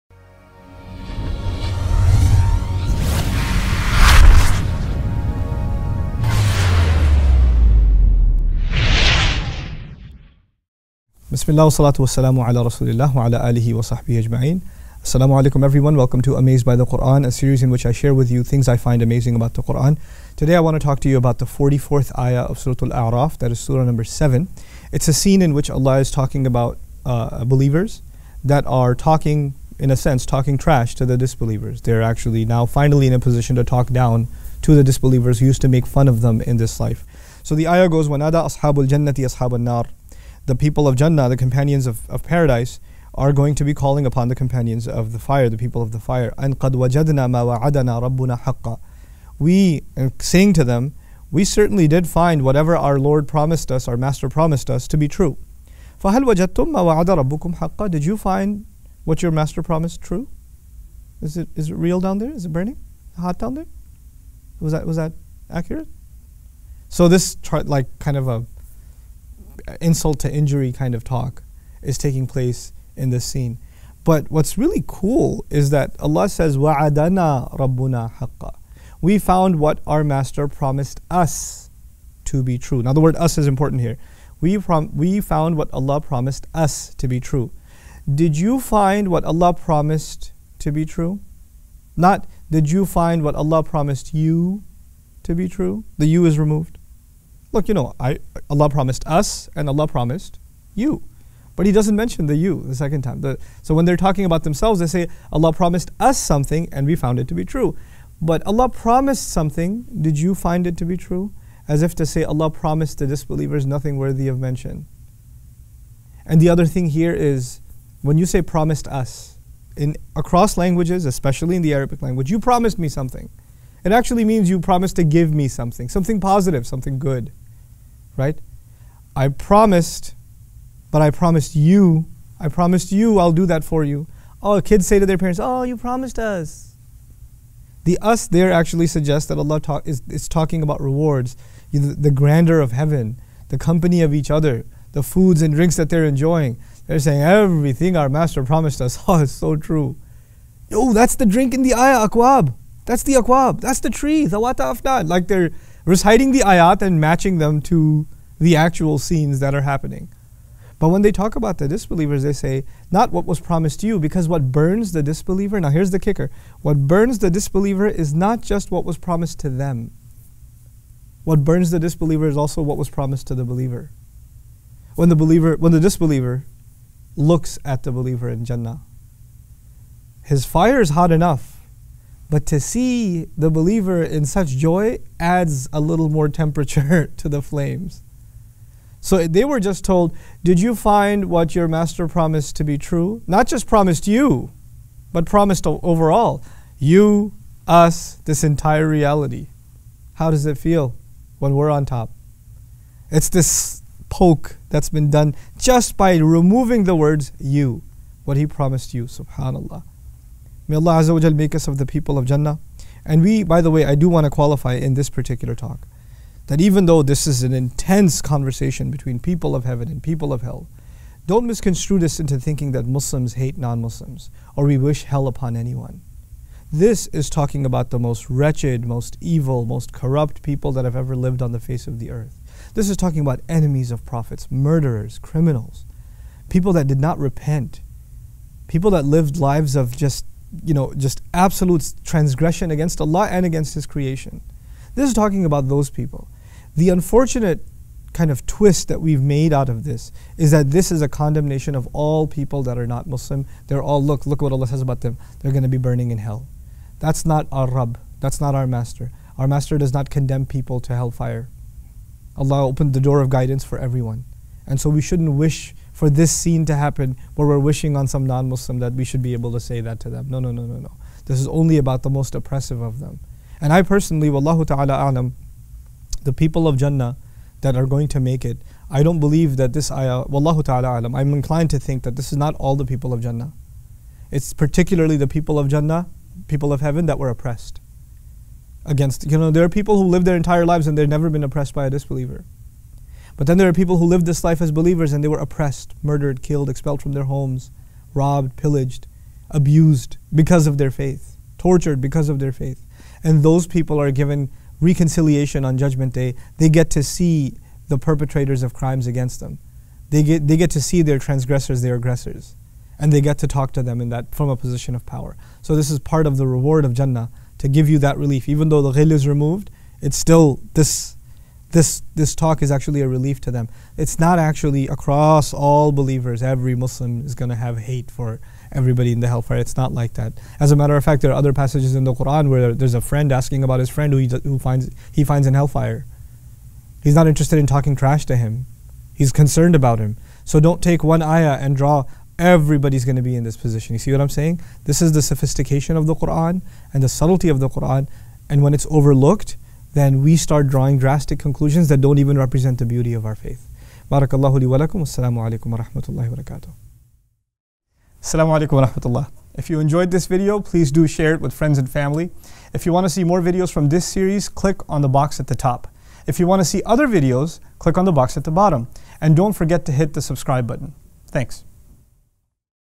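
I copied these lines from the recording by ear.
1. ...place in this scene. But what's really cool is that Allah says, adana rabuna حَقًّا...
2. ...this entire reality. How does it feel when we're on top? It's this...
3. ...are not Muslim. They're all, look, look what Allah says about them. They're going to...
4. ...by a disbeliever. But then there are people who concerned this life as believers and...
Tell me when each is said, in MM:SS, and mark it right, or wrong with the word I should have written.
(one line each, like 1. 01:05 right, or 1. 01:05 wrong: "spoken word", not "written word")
1. 01:12 right
2. 03:18 right
3. 04:12 right
4. 04:51 wrong: "lived", not "concerned".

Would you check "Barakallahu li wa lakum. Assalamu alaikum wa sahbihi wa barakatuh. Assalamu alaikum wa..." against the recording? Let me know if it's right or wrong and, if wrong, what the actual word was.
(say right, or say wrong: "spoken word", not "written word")
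wrong: "rahmatullahi", not "sahbihi".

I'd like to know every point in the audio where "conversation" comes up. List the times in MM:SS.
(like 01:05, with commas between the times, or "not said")
03:38.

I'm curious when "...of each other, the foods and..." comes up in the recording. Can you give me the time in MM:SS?
02:24.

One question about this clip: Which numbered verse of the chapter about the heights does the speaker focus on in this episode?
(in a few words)
44.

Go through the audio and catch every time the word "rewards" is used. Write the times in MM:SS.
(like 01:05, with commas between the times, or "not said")
02:20, 05:16.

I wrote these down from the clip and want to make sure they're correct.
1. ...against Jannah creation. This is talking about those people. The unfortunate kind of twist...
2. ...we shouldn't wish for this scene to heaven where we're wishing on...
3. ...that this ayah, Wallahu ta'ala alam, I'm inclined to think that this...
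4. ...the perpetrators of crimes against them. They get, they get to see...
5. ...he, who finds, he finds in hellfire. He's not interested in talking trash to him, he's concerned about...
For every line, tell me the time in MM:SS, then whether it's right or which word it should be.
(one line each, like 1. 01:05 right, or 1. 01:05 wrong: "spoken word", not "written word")
1. 04:03 wrong: "His", not "Jannah"
2. 04:24 wrong: "happen", not "heaven"
3. 04:39 right
4. 05:07 right
5. 05:34 right.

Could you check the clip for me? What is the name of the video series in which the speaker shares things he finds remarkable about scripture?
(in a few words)
Amazed by the Quran.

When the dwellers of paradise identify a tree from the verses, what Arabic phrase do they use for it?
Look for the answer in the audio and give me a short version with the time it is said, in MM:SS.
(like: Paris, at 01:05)
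wata afnan, at 02:34.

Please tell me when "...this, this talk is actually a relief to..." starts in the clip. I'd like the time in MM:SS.
05:21.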